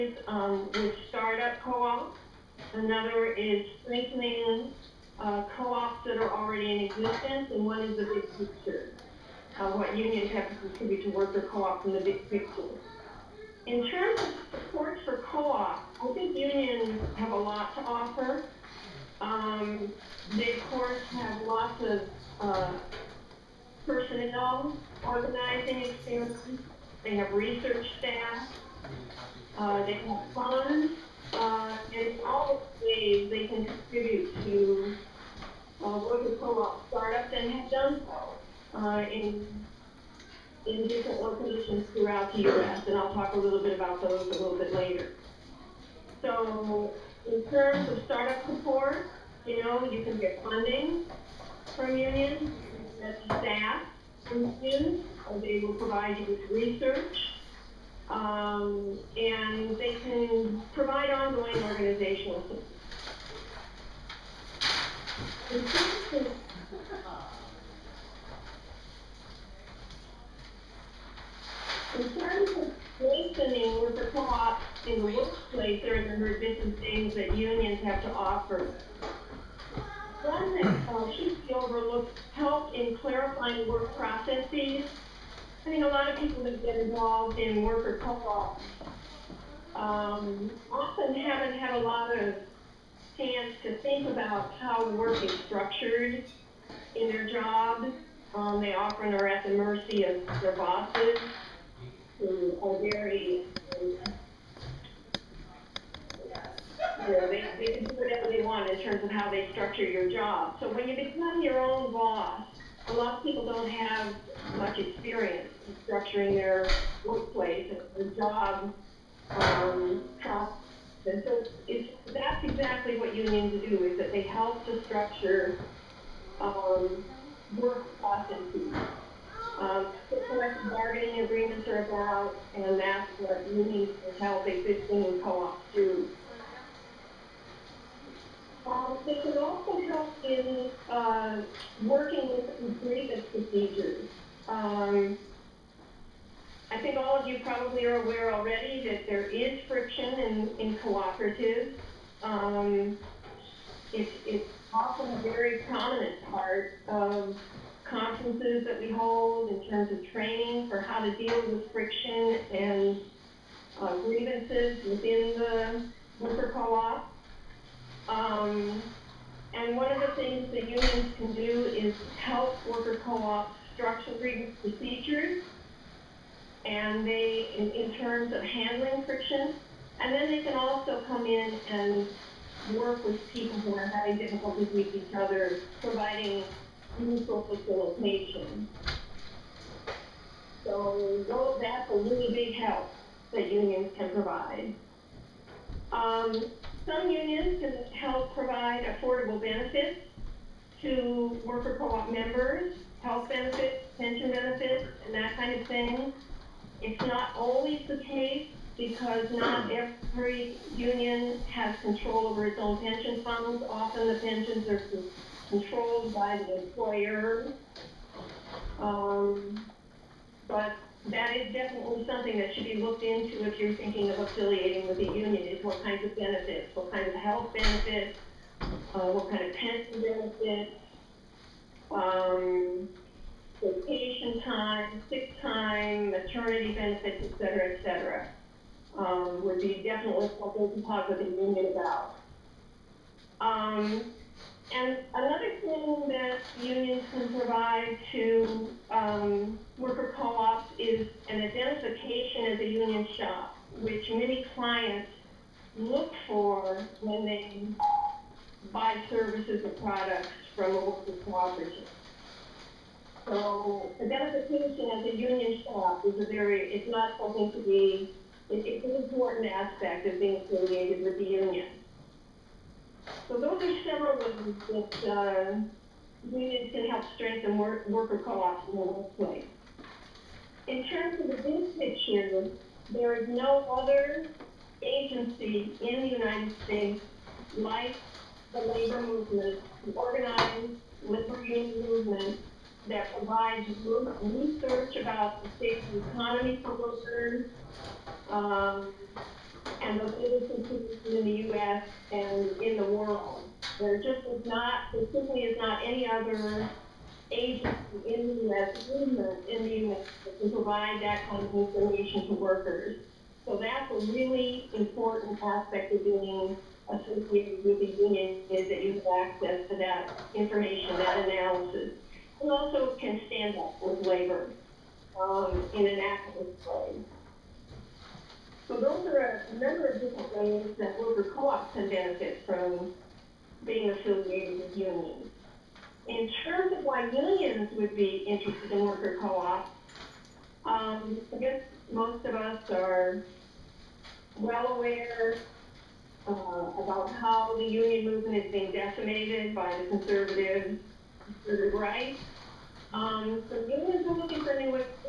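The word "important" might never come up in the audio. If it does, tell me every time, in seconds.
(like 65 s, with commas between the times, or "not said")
268 s, 314 s.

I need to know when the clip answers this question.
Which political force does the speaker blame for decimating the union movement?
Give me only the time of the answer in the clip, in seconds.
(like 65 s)
349 s.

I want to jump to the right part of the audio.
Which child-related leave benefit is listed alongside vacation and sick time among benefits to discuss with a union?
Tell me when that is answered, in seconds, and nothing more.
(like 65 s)
236 s.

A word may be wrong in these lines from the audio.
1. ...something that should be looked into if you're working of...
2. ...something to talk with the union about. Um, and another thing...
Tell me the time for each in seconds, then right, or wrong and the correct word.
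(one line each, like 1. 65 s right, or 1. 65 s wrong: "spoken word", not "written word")
1. 222 s wrong: "thinking", not "working"
2. 240 s right.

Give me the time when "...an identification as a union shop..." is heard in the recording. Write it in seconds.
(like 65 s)
251 s.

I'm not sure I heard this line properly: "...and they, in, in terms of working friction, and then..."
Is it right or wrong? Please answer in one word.
wrong.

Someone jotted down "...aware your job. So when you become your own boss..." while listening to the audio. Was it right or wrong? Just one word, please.
wrong.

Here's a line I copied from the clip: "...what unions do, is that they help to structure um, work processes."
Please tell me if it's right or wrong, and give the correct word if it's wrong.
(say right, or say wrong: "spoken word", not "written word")
right.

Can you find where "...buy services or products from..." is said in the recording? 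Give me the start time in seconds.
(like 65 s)
258 s.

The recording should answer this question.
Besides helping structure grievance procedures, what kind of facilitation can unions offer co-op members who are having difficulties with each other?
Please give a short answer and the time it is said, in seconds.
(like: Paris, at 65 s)
Mutual facilitation, at 186 s.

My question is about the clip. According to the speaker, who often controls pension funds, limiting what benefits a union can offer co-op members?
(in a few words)
The employer.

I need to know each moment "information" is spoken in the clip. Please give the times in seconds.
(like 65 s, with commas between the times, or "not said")
311 s, 320 s.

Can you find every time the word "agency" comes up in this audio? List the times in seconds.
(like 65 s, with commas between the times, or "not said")
284 s, 307 s.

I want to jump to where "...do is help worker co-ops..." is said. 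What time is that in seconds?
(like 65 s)
171 s.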